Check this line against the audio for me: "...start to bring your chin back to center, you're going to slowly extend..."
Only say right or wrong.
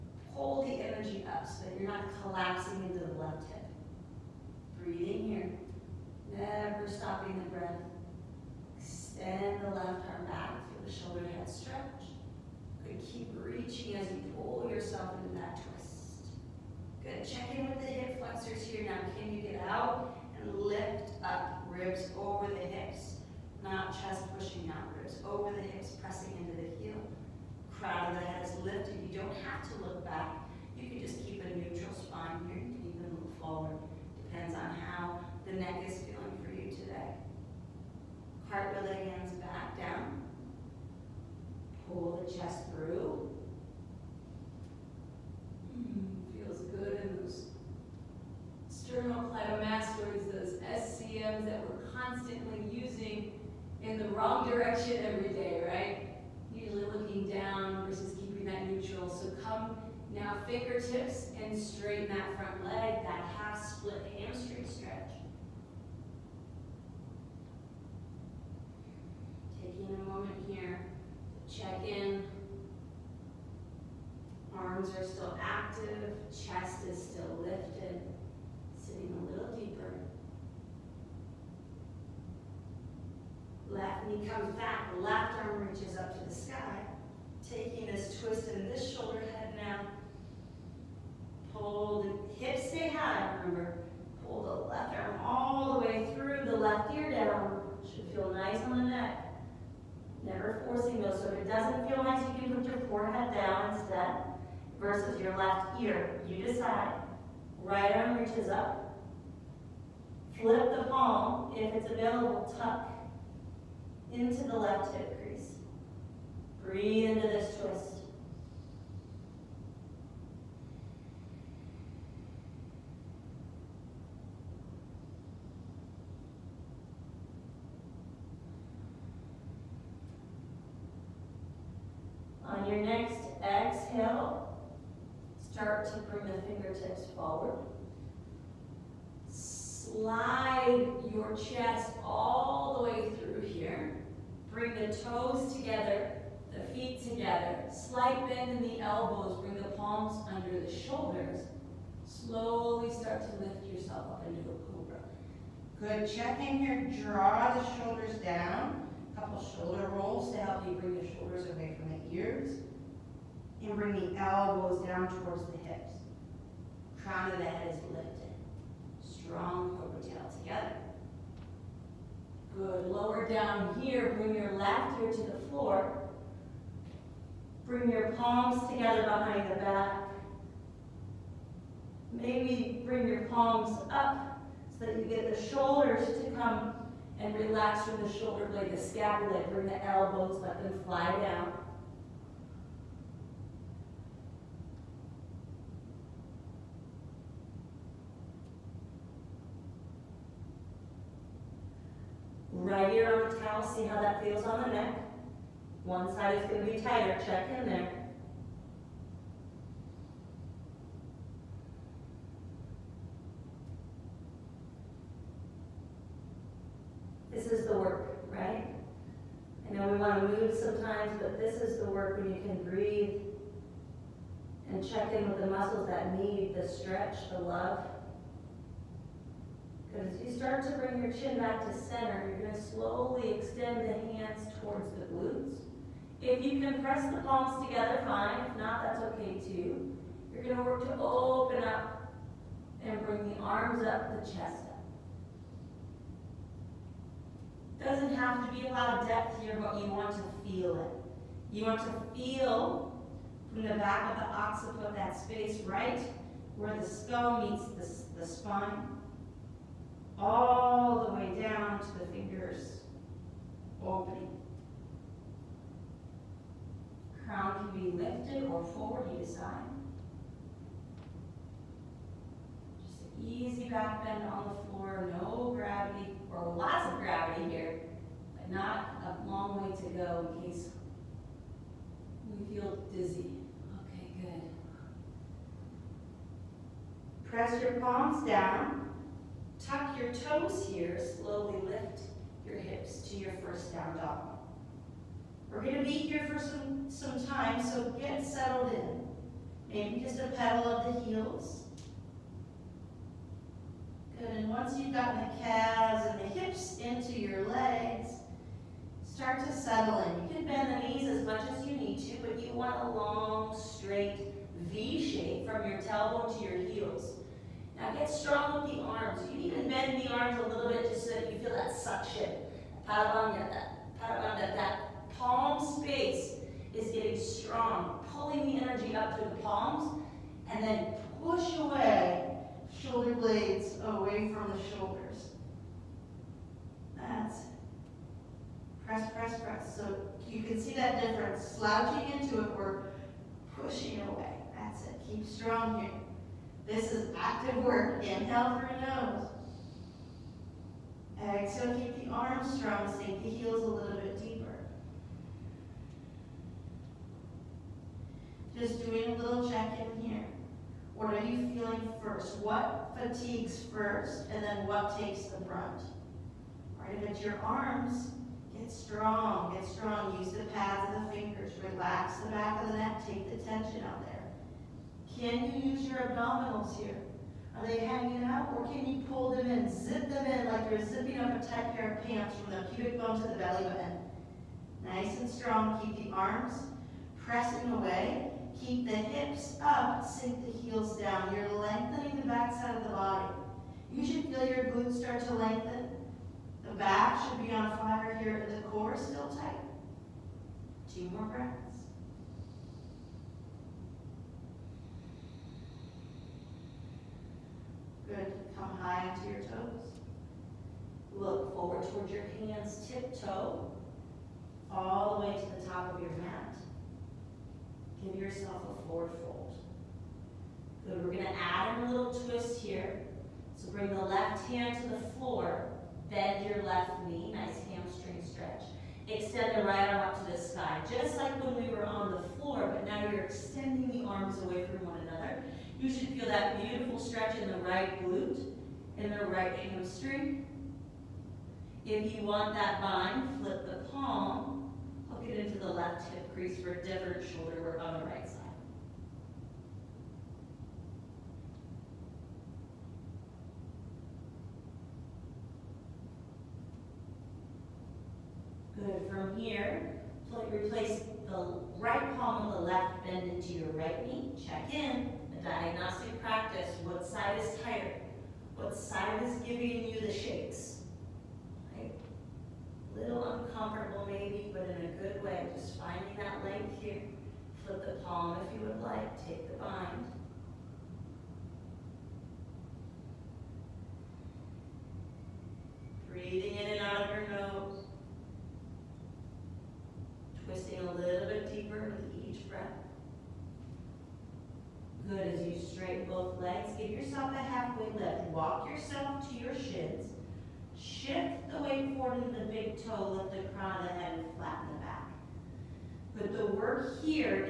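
right.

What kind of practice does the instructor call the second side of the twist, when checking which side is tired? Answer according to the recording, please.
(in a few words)
diagnostic practice.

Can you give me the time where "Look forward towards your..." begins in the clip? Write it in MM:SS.
06:51.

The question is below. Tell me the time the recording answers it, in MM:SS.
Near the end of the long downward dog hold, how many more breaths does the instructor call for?
06:40.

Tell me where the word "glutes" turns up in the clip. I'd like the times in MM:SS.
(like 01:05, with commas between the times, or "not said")
03:55, 06:34, 07:18.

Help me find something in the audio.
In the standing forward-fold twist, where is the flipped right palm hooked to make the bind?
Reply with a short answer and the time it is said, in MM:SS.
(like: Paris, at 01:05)
left hip crease, at 07:25.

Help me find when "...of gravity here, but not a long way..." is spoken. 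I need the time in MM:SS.
04:36.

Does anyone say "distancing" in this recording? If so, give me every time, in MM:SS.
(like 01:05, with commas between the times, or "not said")
not said.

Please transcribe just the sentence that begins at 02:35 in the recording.
Good, check in here, draw the shoulders down.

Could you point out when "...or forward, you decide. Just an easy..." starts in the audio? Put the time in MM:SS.
04:28.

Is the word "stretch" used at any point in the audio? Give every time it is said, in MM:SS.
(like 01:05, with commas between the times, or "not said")
03:46, 07:08, 07:16.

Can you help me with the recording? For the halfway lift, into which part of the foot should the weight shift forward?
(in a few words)
big toe.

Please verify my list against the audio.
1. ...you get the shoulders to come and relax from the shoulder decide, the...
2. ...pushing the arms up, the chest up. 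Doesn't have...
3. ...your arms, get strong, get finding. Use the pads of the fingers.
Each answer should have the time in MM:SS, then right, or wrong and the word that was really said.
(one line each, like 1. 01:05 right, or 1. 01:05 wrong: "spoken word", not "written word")
1. 03:04 wrong: "blade", not "decide"
2. 04:03 wrong: "bring", not "pushing"
3. 06:07 wrong: "strong", not "finding".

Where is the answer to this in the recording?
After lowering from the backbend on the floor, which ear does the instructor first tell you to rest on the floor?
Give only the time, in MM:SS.
02:54.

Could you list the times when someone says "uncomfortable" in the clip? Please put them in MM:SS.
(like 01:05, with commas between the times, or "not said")
07:53.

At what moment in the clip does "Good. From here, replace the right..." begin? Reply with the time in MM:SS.
07:38.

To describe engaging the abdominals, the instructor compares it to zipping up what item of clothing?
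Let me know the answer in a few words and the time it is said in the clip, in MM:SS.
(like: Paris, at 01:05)
a tight pair of pants, at 06:21.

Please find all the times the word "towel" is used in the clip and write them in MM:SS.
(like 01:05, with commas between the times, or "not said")
03:23.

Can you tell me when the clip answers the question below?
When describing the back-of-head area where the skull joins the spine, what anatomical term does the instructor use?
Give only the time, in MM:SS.
04:14.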